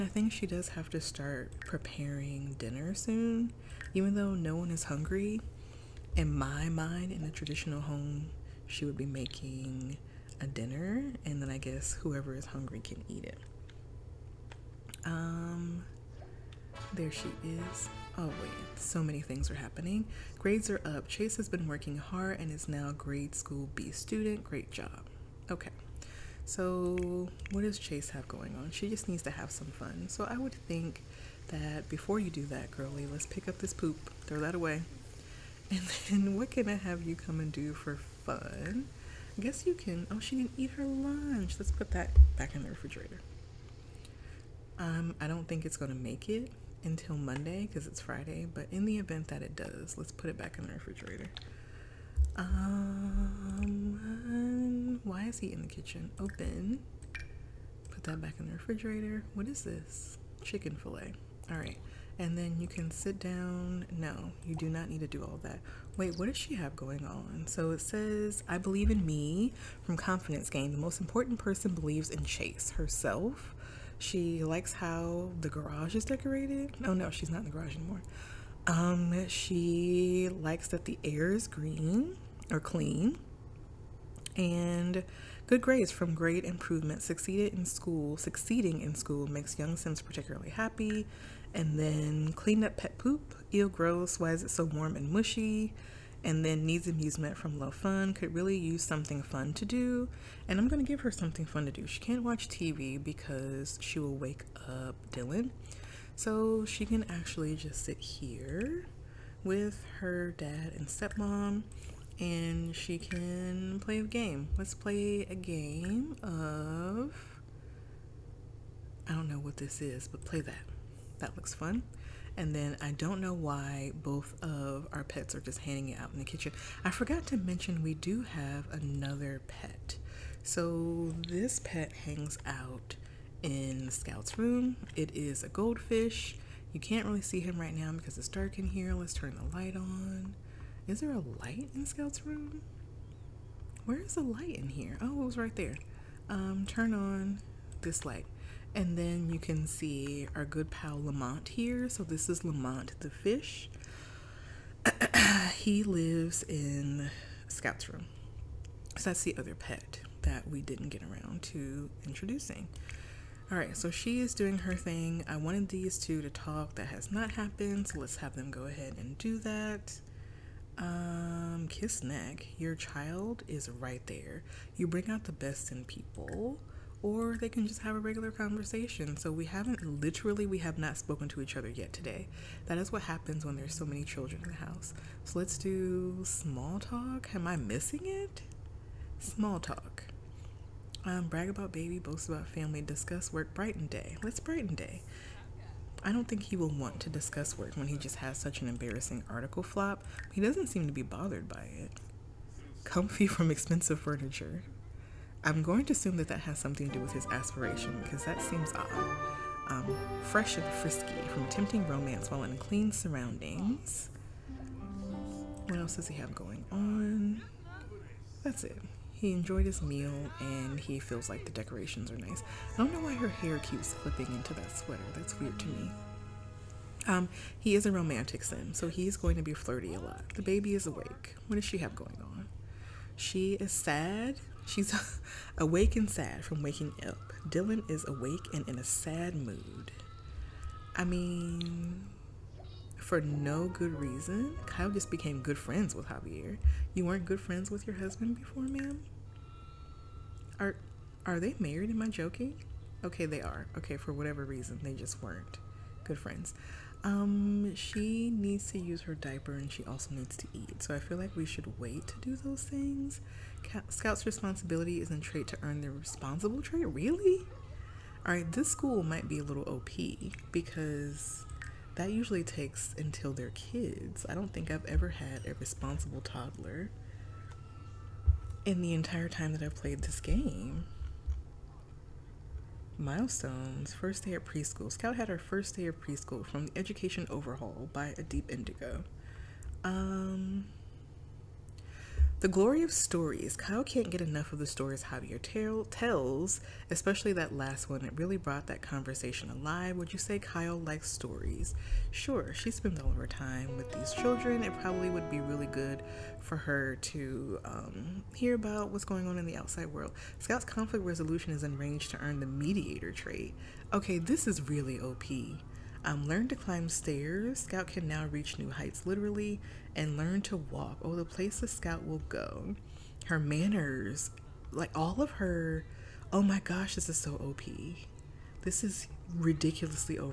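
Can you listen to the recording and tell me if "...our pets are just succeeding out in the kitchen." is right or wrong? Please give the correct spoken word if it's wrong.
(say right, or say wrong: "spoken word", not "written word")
wrong: "hanging", not "succeeding".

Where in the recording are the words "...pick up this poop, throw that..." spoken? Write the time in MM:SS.
00:33.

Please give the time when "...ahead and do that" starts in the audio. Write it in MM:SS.
02:48.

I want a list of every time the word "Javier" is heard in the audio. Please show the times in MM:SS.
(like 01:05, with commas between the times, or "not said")
04:06, 04:55.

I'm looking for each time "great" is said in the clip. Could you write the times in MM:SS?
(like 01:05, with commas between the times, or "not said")
00:24, 01:26.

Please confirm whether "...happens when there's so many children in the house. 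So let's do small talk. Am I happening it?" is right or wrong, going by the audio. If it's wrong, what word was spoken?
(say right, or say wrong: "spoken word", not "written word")
wrong: "missing", not "happening".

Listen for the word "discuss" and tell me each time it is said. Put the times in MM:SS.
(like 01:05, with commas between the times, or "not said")
03:12, 03:17.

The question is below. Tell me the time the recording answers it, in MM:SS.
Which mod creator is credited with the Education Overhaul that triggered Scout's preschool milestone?
04:48.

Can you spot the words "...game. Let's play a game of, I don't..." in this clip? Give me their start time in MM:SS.
01:54.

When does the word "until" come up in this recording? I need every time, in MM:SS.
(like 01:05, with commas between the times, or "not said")
00:46, 04:32.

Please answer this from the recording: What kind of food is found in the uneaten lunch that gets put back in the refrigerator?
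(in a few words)
Chicken filet.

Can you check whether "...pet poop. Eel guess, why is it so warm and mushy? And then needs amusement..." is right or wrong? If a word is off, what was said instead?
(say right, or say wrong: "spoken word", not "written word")
wrong: "gross", not "guess".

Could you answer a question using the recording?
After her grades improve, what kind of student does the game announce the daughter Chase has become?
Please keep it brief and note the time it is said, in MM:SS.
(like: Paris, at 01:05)
grade school B student, at 00:22.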